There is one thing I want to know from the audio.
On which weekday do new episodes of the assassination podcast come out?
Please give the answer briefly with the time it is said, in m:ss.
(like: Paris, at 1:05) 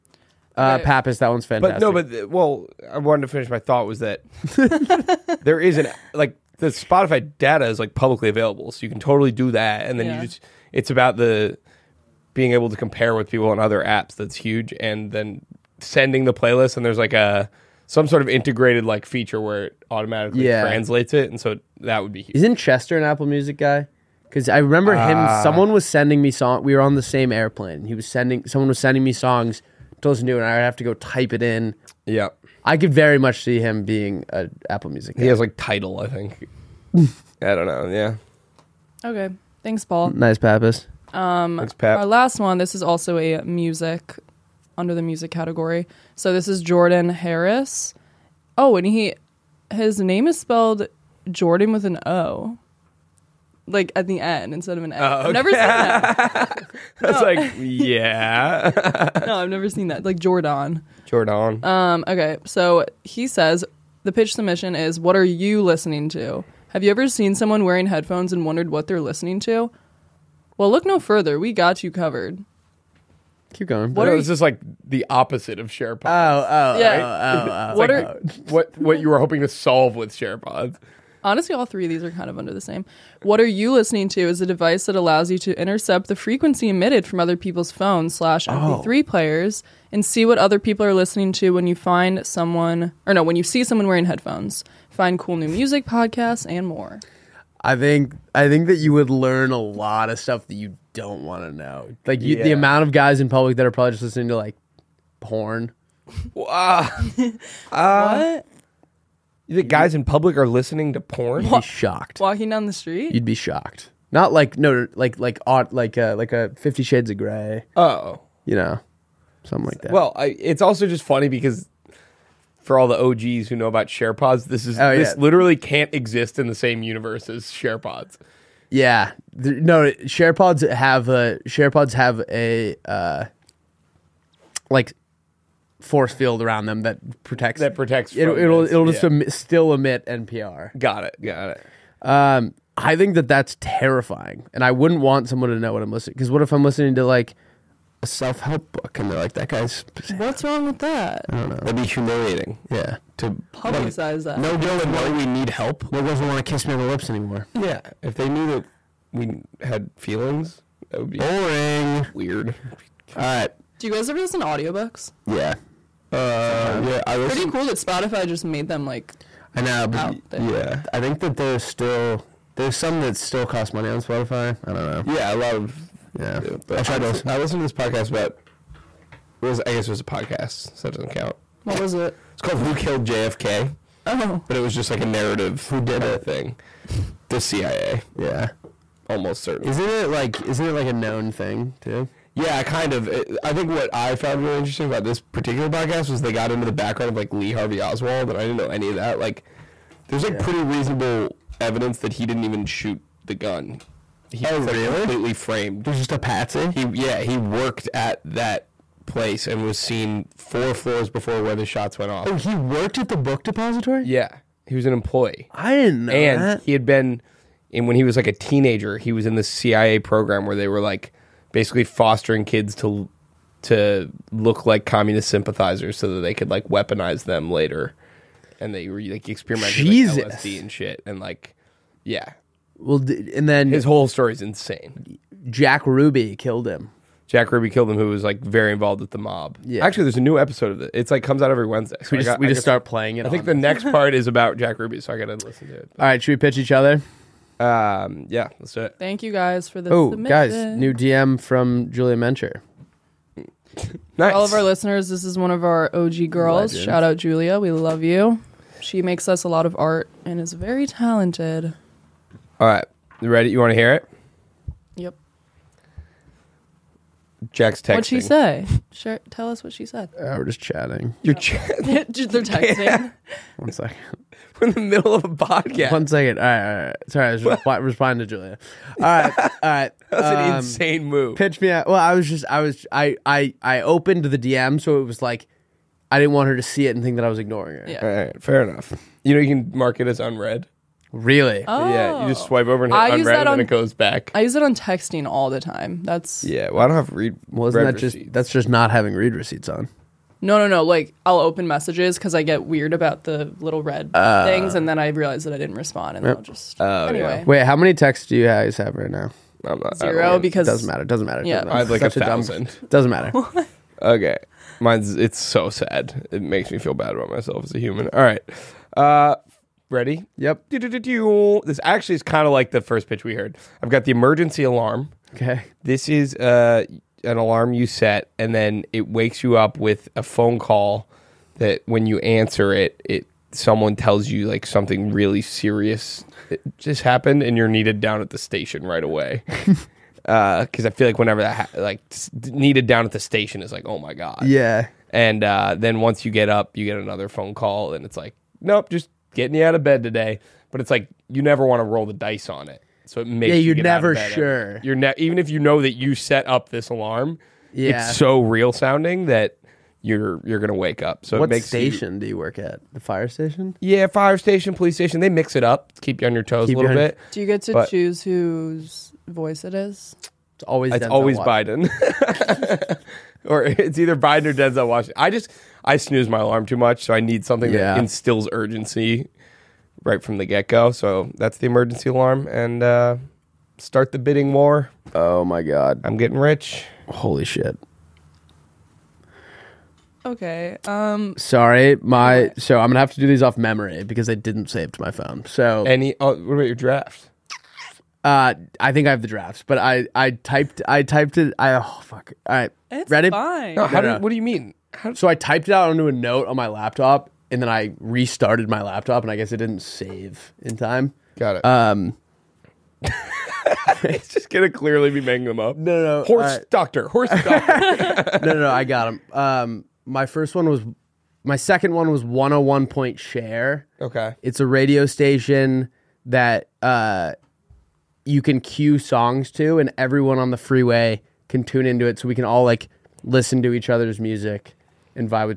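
Wednesday, at 4:01.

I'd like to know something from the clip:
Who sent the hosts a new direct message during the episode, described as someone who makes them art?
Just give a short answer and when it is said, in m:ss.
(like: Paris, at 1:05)
Julia Mencher, at 4:11.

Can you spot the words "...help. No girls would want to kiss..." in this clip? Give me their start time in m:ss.
2:35.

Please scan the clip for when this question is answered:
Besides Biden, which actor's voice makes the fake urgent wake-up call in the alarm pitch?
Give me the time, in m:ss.
6:14.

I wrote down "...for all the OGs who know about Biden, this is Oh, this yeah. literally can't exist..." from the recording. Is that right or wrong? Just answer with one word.
wrong.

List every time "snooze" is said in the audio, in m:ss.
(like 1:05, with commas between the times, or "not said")
6:15.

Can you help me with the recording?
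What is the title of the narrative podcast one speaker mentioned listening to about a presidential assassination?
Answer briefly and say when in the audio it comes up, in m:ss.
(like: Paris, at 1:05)
Who Killed JFK, at 3:02.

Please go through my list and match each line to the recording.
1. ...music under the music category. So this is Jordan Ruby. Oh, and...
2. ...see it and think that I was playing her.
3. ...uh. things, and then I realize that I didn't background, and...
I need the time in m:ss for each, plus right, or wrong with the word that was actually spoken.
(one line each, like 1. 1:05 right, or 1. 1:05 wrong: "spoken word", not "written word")
1. 0:43 wrong: "Harris", not "Ruby"
2. 4:46 wrong: "ignoring", not "playing"
3. 5:04 wrong: "respond", not "background".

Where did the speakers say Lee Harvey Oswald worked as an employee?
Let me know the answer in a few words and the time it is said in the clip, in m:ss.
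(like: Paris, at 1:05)
The book depository, at 3:33.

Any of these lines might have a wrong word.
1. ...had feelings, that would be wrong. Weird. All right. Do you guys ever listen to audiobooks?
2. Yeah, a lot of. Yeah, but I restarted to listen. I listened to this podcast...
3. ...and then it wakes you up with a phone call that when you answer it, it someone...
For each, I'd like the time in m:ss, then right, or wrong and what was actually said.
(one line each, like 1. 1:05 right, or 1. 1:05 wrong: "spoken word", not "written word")
1. 2:39 wrong: "boring", not "wrong"
2. 2:55 wrong: "tried", not "restarted"
3. 5:28 right.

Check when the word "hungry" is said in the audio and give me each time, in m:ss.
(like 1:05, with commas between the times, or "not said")
not said.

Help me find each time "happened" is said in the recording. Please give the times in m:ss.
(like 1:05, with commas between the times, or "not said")
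5:37.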